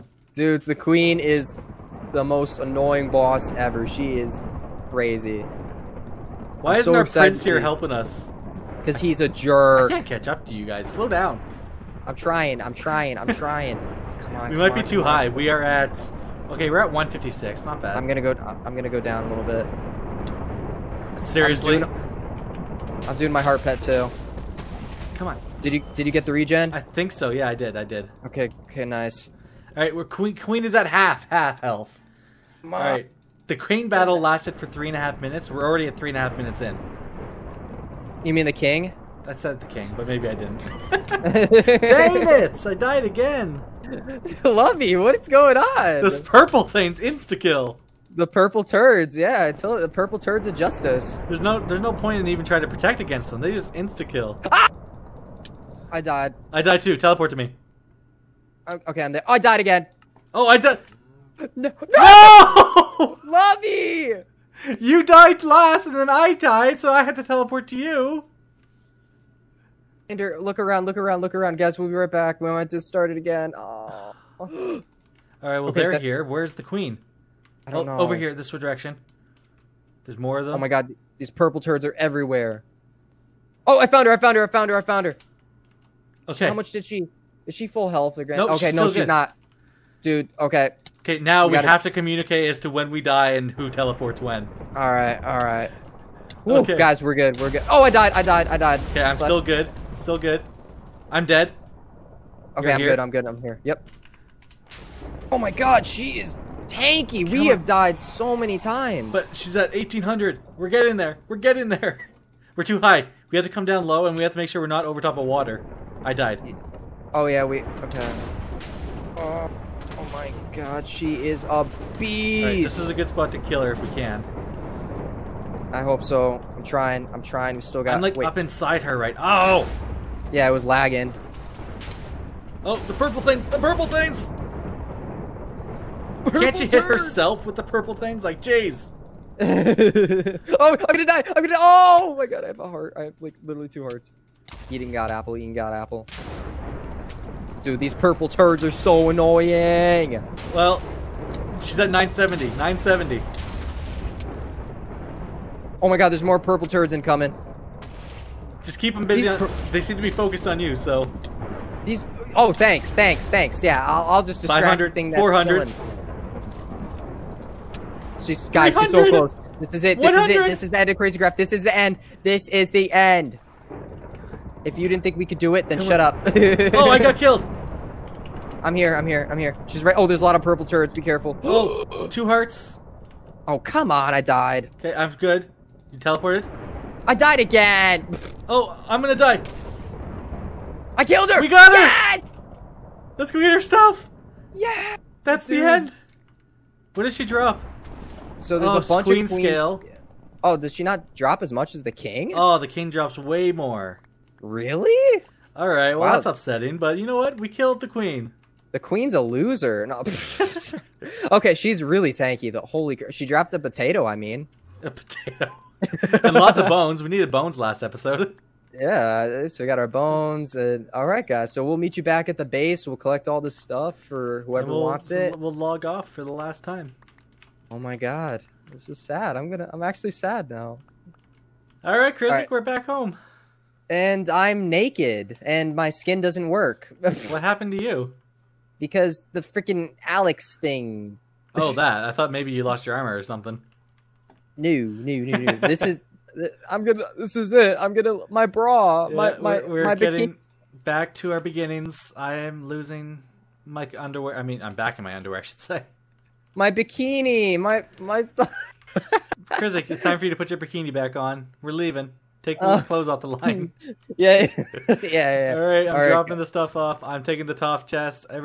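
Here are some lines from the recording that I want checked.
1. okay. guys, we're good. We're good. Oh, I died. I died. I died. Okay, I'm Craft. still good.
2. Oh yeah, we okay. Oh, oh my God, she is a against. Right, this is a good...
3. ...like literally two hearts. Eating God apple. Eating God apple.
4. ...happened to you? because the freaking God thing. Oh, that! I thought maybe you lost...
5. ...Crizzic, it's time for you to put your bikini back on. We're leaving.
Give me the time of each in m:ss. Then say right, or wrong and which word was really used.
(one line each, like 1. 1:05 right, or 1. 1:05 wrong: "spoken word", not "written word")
1. 1:36 wrong: "Slash", not "Craft"
2. 1:57 wrong: "beast", not "against"
3. 2:23 right
4. 3:57 wrong: "Alex", not "God"
5. 4:19 right.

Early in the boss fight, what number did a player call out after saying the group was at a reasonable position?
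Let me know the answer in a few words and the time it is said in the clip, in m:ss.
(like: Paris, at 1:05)
156, at 0:16.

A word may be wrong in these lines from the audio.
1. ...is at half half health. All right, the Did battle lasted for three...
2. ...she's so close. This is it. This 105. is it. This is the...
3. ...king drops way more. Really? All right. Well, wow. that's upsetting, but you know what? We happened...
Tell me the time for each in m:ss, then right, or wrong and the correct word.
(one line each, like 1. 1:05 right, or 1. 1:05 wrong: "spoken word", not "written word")
1. 0:30 wrong: "Queen", not "Did"
2. 2:48 wrong: "100", not "105"
3. 3:22 wrong: "killed", not "happened".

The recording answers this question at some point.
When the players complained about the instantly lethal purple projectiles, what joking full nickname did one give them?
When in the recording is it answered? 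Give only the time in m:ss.
0:49.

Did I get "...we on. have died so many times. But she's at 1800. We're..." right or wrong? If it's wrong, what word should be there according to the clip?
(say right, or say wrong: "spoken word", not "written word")
right.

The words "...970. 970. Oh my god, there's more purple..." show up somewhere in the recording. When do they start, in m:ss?
2:31.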